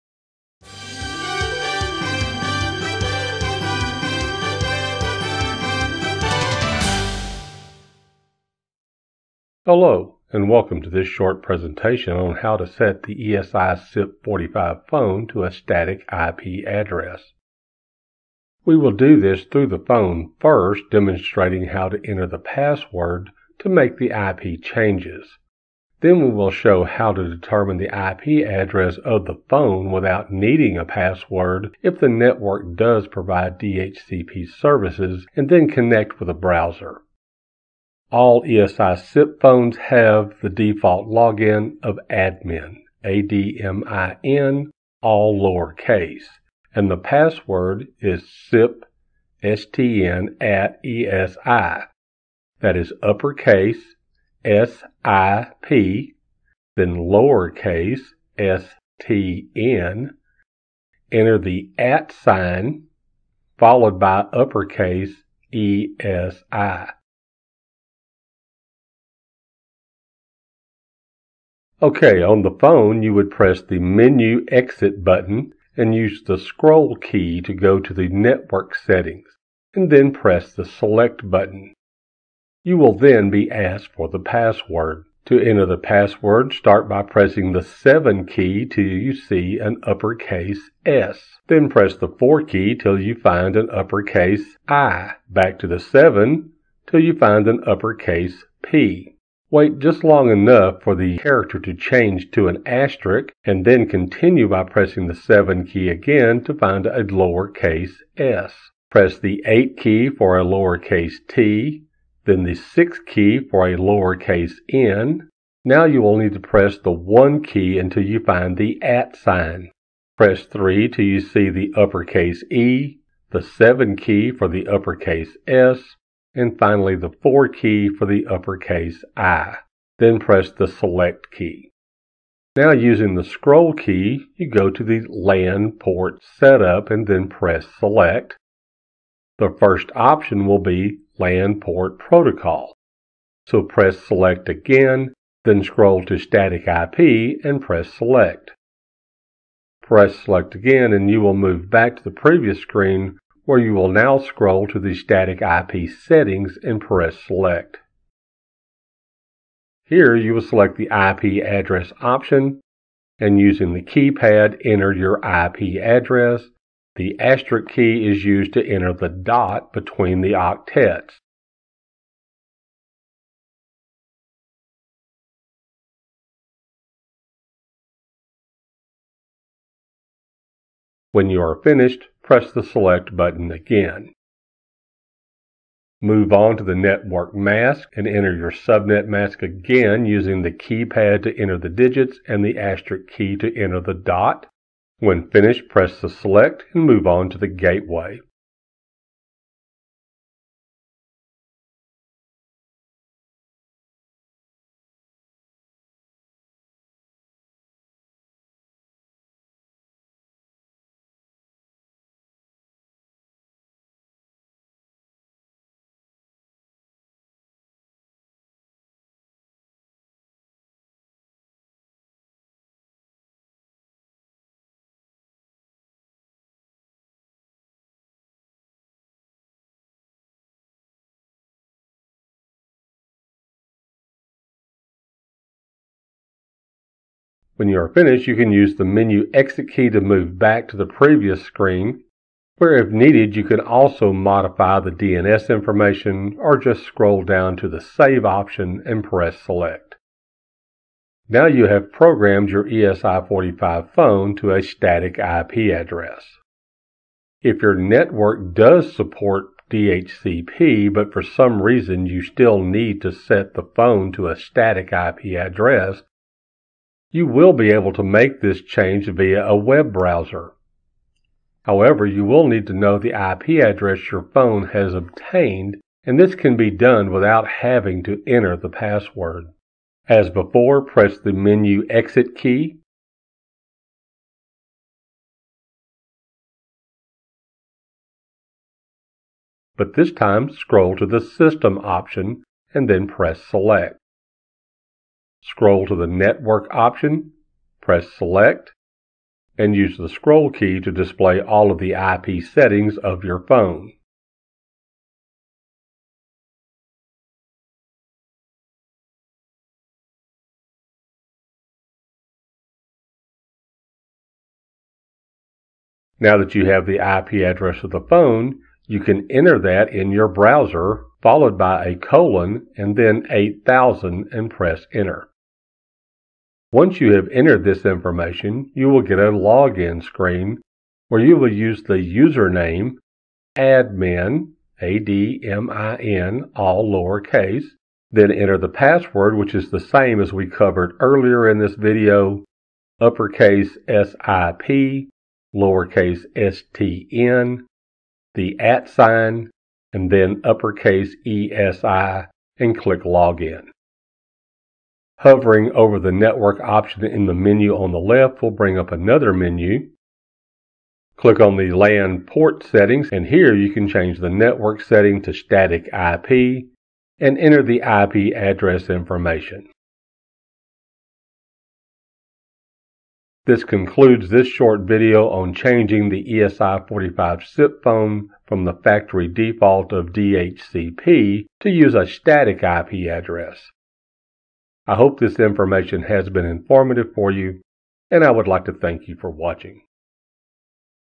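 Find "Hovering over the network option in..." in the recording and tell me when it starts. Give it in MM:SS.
05:55.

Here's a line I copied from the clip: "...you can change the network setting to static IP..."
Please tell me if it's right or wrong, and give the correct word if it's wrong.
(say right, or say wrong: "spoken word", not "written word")
right.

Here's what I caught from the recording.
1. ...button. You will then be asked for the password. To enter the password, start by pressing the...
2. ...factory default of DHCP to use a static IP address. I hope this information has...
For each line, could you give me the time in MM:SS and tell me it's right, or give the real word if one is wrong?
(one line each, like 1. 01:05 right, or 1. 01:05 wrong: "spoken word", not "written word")
1. 01:21 right
2. 06:18 right.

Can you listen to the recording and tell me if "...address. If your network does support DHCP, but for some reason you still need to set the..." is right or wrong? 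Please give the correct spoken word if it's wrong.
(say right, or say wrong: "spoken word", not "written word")
right.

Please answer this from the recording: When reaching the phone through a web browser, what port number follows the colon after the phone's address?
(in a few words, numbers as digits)
8000.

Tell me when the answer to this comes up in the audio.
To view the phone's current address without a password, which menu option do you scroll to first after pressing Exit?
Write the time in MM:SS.
04:51.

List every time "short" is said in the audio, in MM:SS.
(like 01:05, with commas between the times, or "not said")
00:11, 06:14.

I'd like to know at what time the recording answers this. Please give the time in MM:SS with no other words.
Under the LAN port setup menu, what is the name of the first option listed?
02:21.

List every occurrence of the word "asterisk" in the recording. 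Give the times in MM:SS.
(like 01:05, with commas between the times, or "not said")
01:42, 02:47, 03:12.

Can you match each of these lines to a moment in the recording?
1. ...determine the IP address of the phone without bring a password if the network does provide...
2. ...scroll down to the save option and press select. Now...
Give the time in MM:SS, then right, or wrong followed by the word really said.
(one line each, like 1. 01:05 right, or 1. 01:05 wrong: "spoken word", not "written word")
1. 00:27 wrong: "needing", not "bring"
2. 04:06 right.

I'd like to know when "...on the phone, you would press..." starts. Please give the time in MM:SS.
01:12.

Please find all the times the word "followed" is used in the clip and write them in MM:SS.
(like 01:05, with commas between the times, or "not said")
01:03, 05:21.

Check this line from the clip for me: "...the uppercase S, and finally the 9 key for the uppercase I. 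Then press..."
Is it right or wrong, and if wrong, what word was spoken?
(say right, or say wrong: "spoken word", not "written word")
wrong: "4", not "9".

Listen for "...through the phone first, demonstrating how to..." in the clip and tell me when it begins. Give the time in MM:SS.
00:19.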